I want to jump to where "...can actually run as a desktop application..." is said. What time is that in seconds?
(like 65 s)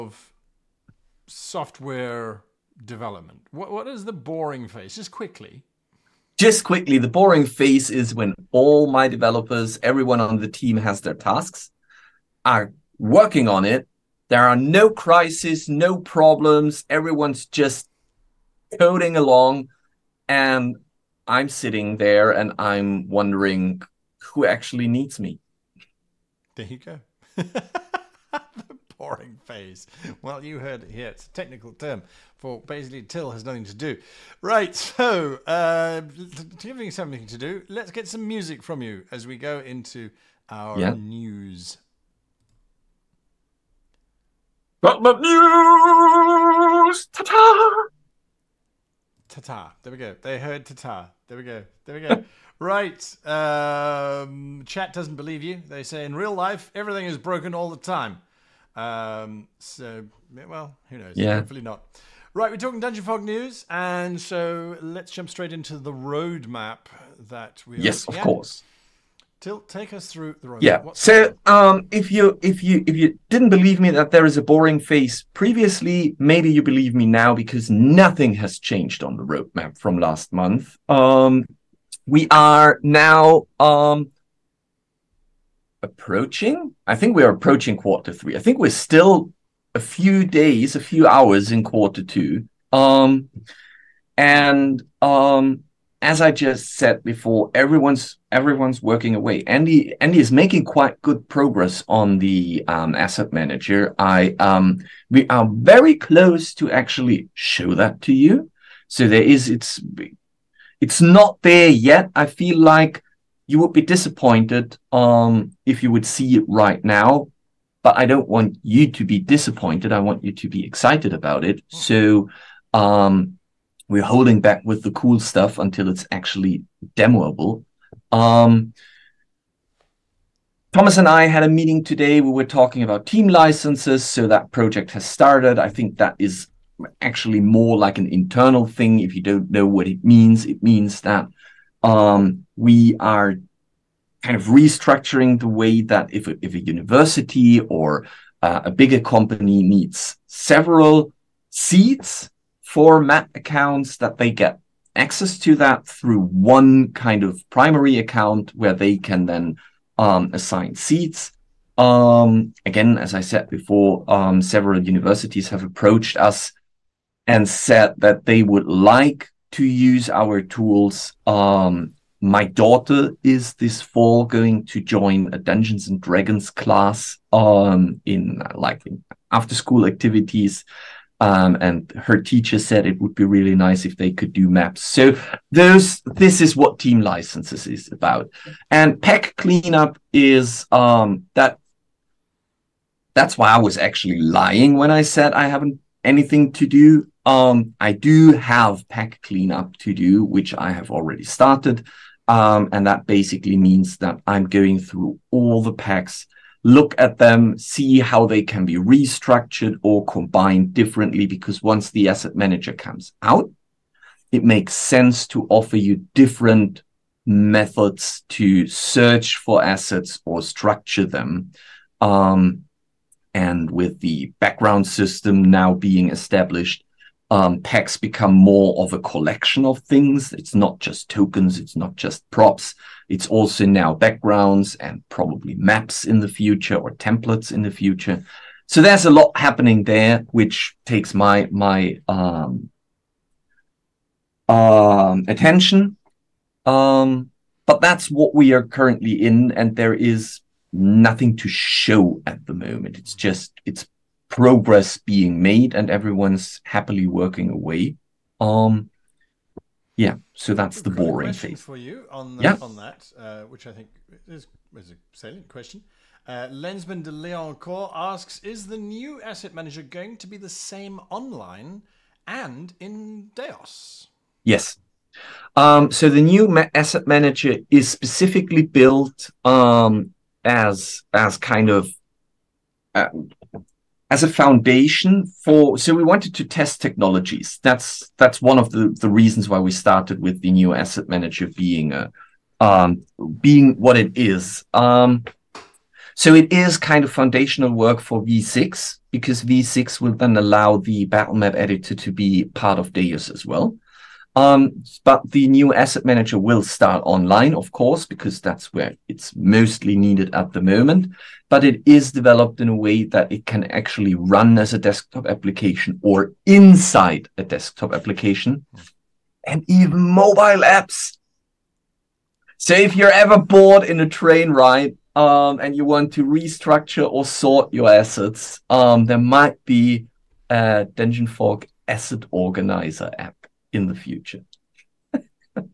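313 s.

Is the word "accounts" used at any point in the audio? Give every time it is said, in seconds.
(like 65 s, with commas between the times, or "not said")
153 s, 157 s.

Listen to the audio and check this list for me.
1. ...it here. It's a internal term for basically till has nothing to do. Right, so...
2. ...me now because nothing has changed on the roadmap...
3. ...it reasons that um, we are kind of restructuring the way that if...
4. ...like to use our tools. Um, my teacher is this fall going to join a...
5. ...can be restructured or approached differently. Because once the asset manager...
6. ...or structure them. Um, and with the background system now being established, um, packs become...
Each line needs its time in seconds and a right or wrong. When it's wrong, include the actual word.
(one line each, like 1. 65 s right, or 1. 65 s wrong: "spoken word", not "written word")
1. 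30 s wrong: "technical", not "internal"
2. 76 s right
3. 140 s wrong: "means", not "reasons"
4. 168 s wrong: "daughter", not "teacher"
5. 208 s wrong: "combined", not "approached"
6. 220 s right.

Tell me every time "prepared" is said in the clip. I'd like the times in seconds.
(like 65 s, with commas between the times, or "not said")
not said.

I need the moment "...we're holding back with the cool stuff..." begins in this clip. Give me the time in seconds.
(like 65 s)
123 s.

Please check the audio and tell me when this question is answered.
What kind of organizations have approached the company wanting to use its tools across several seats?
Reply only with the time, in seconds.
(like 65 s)
164 s.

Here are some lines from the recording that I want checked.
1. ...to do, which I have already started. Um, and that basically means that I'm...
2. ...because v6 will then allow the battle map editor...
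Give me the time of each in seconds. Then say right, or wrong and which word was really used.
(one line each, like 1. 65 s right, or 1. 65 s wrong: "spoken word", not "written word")
1. 199 s right
2. 299 s right.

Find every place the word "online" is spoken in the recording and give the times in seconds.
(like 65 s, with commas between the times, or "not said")
271 s, 307 s.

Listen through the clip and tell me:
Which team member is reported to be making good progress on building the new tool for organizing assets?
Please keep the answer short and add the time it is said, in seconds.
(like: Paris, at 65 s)
Andy, at 99 s.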